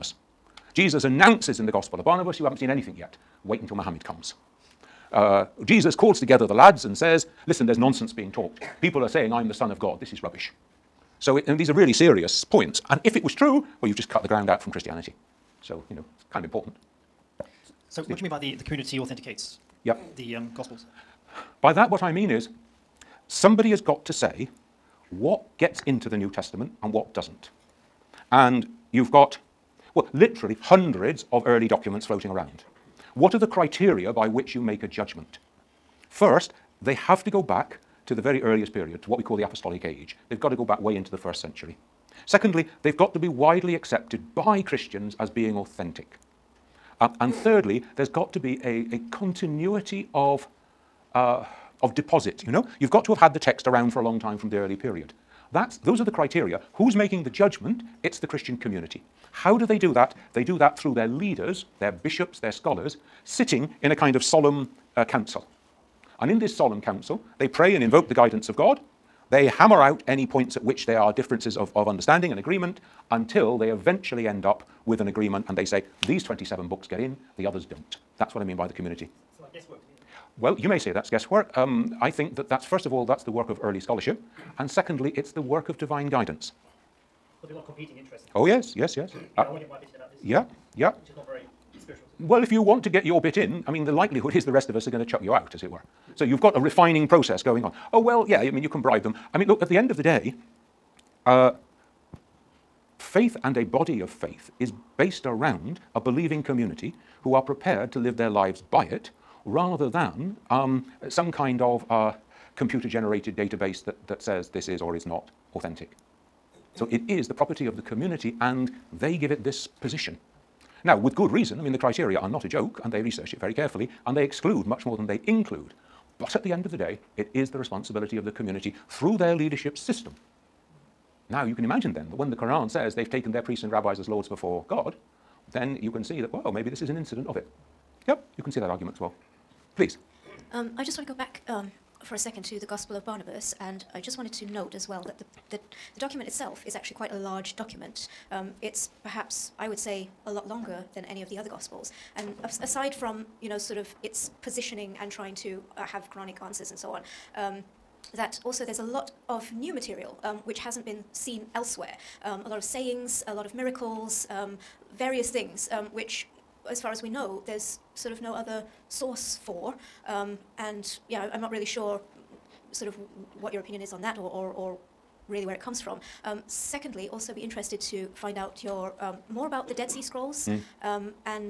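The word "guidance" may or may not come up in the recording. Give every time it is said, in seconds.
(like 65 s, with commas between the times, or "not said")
68 s, 86 s.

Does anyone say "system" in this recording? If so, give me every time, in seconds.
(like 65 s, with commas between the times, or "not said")
129 s.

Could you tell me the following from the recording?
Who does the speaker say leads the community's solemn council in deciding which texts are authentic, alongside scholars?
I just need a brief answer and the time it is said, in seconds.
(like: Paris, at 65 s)
bishops, at 61 s.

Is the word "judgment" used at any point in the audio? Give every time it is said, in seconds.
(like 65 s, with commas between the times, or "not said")
34 s, 57 s.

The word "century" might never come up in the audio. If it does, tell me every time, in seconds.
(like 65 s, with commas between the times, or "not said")
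41 s.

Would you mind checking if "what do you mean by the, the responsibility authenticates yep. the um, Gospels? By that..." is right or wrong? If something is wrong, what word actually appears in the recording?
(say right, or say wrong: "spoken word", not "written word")
wrong: "community", not "responsibility".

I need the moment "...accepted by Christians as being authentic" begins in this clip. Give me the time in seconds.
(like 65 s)
43 s.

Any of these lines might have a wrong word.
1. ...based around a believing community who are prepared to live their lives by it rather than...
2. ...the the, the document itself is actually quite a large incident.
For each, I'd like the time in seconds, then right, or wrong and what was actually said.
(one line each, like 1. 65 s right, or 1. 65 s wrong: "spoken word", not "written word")
1. 104 s right
2. 145 s wrong: "document", not "incident".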